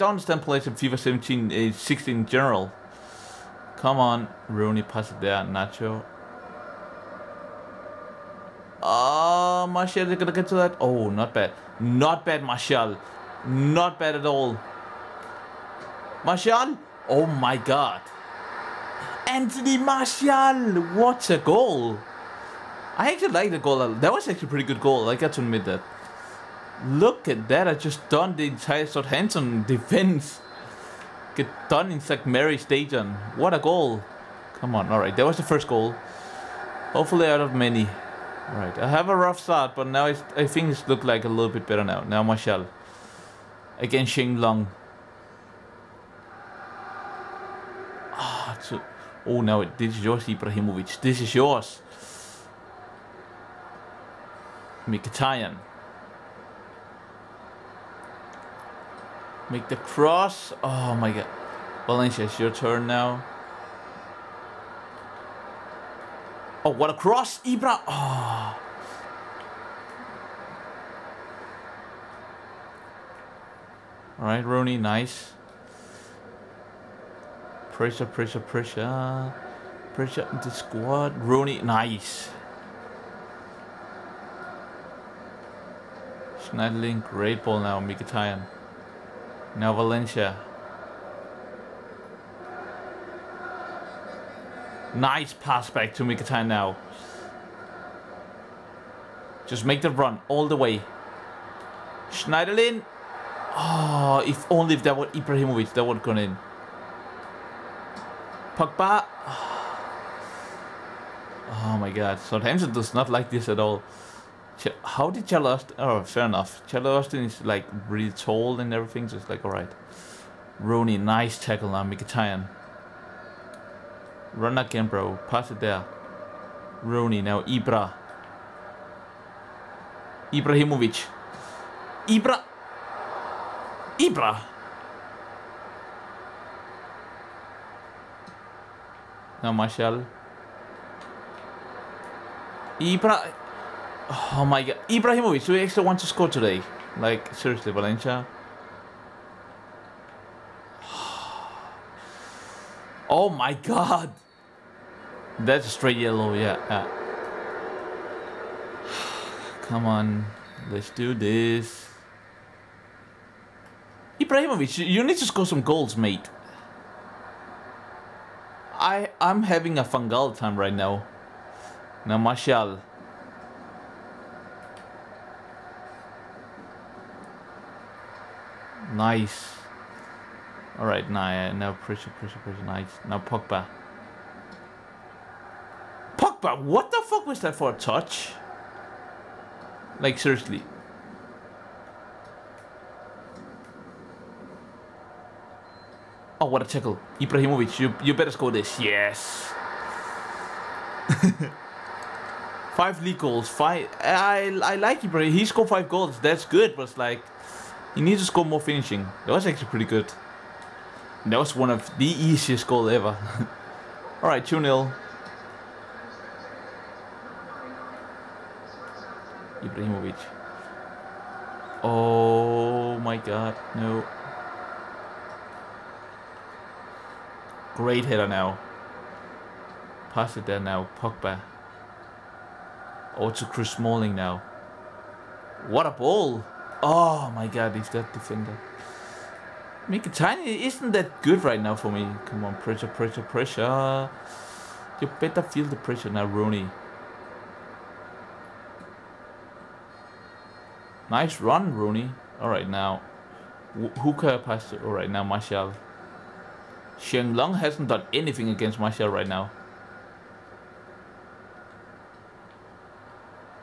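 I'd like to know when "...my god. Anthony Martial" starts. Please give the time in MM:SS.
00:17.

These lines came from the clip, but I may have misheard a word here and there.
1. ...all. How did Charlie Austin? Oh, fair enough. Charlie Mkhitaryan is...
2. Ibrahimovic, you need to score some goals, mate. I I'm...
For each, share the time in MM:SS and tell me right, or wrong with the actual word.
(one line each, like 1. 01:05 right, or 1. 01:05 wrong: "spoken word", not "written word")
1. 01:53 wrong: "Austin", not "Mkhitaryan"
2. 02:44 right.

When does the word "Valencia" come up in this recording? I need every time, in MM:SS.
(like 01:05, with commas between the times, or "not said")
01:01, 01:29, 02:27.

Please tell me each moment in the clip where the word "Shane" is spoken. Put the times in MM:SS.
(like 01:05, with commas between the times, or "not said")
00:44, 04:16.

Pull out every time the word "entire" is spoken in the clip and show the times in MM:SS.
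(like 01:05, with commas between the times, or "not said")
00:28.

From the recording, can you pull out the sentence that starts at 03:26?
That's good, but it's like, he needs to score more finishing.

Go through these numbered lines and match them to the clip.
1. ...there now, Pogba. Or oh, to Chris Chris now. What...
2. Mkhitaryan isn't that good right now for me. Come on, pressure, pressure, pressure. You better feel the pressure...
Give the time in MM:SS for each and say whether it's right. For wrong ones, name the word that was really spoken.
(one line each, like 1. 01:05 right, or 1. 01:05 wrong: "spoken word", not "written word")
1. 03:50 wrong: "Smalling", not "Chris"
2. 03:59 right.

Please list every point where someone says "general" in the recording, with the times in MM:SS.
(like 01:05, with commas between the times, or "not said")
00:02.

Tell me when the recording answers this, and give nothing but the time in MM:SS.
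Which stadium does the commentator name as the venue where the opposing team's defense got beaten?
00:31.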